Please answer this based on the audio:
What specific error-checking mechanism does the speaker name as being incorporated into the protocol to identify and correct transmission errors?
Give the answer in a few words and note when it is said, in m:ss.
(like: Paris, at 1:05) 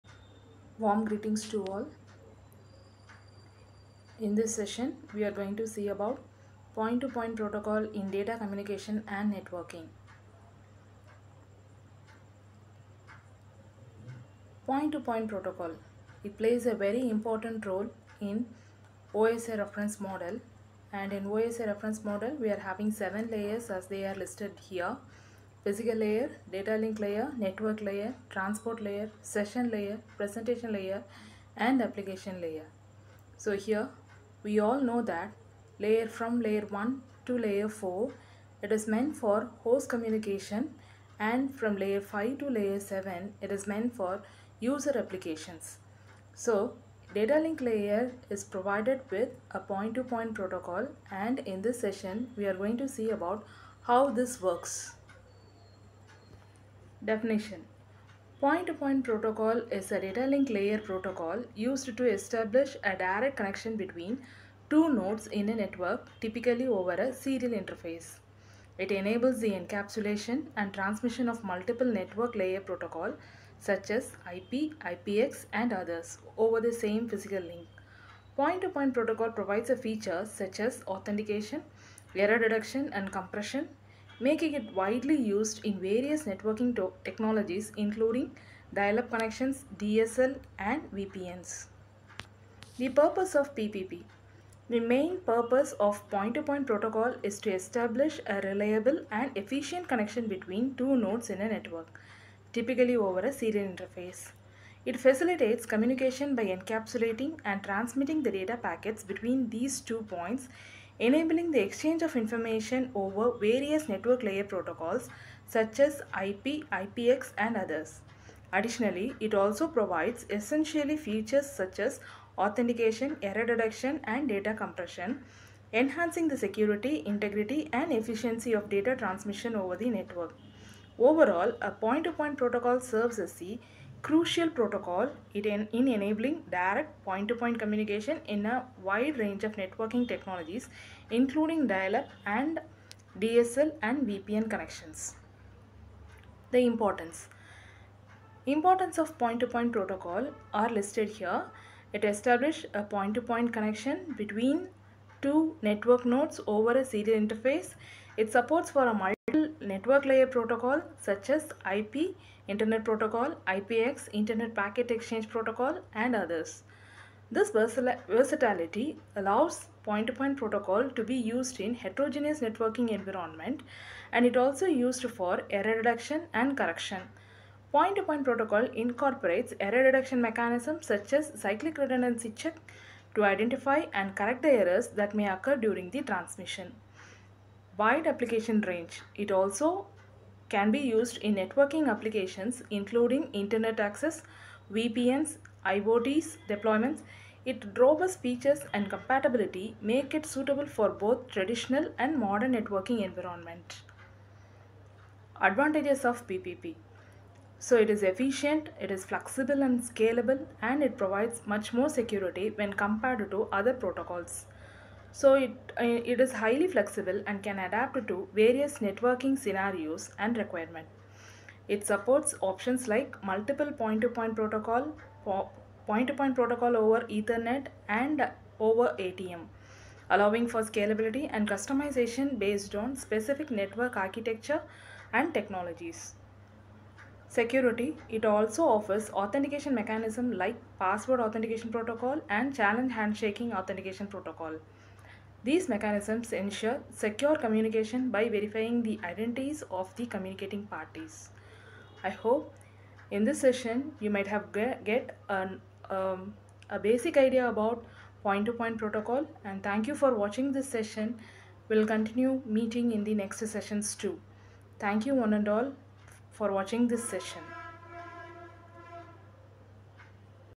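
Cyclic redundancy check, at 3:01.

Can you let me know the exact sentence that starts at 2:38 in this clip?
It supports for a multi network layer protocol such as IP, Internet Protocol, IPX, Internet Packet Exchange Protocol and others.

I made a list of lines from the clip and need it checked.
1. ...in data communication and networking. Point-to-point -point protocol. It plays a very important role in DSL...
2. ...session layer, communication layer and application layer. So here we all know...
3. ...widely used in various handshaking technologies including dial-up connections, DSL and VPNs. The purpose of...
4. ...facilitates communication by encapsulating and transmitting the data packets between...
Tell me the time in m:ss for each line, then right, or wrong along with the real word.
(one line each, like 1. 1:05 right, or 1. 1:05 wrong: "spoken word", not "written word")
1. 0:07 wrong: "OSI", not "DSL"
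2. 0:29 wrong: "presentation", not "communication"
3. 1:24 wrong: "networking", not "handshaking"
4. 1:45 right.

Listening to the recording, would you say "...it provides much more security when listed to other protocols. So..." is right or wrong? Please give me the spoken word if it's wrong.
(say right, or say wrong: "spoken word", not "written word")
wrong: "compared", not "listed".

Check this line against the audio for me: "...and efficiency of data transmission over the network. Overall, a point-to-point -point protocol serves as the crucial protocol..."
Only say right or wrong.
right.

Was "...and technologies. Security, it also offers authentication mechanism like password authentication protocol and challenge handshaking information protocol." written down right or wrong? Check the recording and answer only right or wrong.
wrong.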